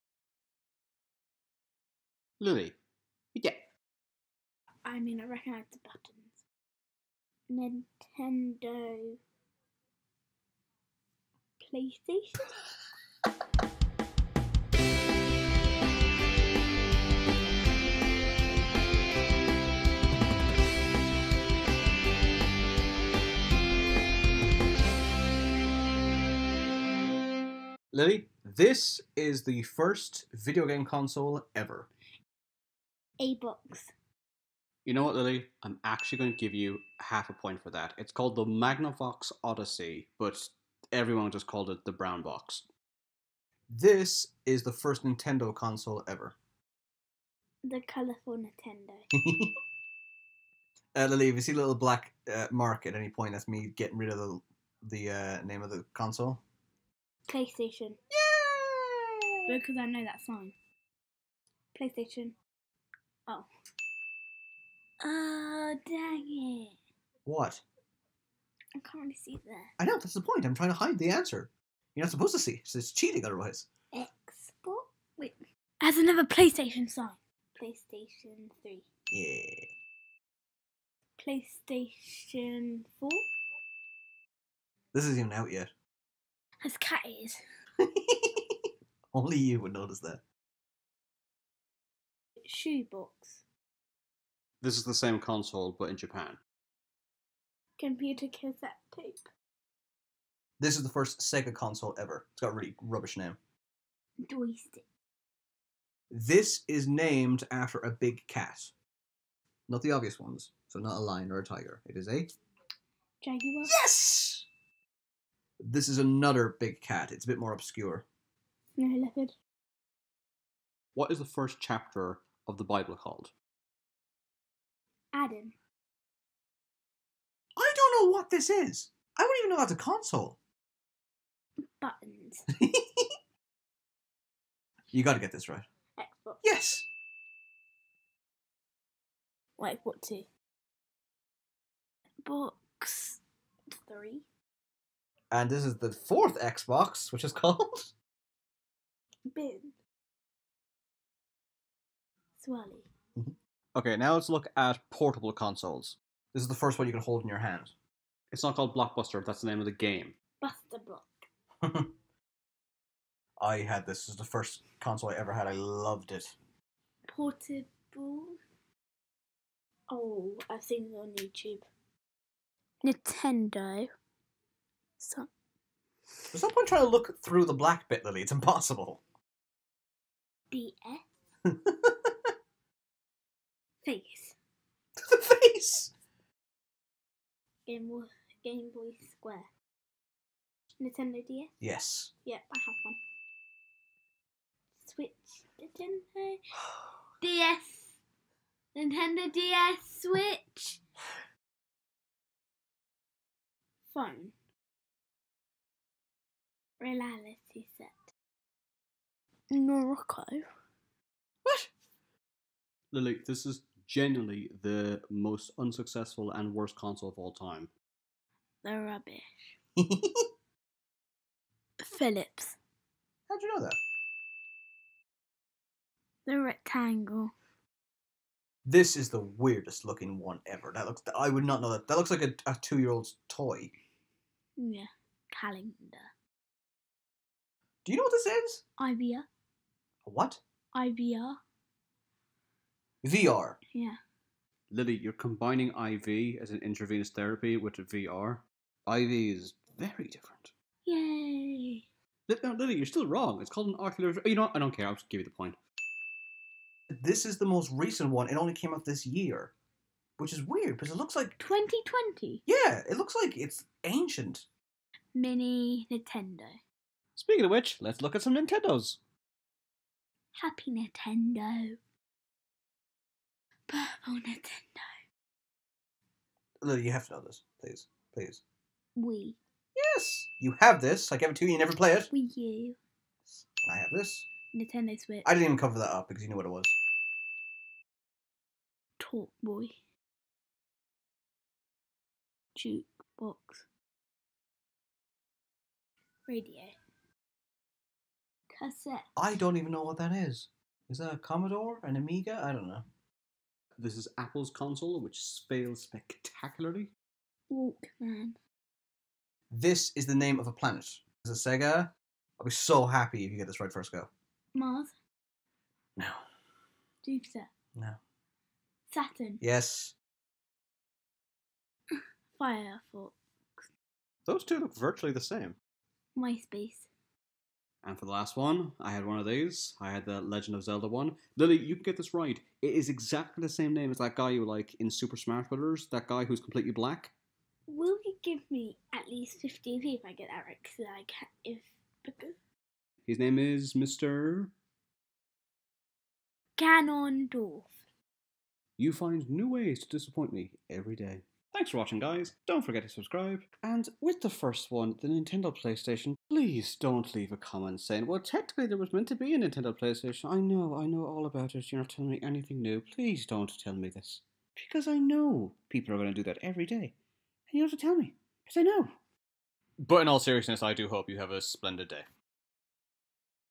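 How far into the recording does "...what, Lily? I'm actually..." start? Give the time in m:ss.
0:35.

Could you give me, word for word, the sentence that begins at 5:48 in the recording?
You find new ways to disappoint me every day.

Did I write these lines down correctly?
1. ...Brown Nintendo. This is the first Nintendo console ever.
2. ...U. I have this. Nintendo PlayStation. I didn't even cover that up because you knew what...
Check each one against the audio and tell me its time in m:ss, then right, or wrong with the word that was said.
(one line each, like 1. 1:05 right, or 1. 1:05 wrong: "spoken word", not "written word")
1. 0:41 wrong: "Box", not "Nintendo"
2. 4:42 wrong: "Switch", not "PlayStation".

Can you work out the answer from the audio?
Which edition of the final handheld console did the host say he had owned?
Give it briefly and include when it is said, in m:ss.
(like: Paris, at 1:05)
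The Legend of Zelda, at 5:30.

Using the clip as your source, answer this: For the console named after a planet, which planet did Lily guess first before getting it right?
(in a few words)
Mars.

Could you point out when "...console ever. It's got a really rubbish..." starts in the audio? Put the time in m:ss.
1:41.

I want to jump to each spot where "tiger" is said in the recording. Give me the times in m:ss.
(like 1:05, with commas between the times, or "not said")
1:51.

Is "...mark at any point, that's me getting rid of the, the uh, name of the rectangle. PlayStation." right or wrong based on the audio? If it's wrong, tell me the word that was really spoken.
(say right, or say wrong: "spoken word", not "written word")
wrong: "console", not "rectangle".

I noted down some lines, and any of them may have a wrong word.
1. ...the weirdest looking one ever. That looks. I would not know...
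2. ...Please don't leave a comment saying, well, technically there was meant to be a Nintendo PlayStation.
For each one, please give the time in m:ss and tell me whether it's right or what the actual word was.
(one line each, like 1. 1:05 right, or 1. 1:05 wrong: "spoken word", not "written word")
1. 3:49 right
2. 5:56 right.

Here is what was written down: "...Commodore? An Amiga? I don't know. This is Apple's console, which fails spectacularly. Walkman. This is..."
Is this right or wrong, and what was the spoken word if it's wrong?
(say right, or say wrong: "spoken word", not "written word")
right.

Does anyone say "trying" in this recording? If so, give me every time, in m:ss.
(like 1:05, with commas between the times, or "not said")
1:10, 2:56.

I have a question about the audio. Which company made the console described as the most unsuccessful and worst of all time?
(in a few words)
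Philips.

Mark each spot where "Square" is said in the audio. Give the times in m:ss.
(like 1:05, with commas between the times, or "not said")
3:09.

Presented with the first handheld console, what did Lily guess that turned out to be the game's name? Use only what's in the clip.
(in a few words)
Blockbuster.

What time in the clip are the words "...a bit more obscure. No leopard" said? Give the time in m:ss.
1:57.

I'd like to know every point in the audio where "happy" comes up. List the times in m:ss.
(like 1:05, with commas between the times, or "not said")
4:30, 5:12.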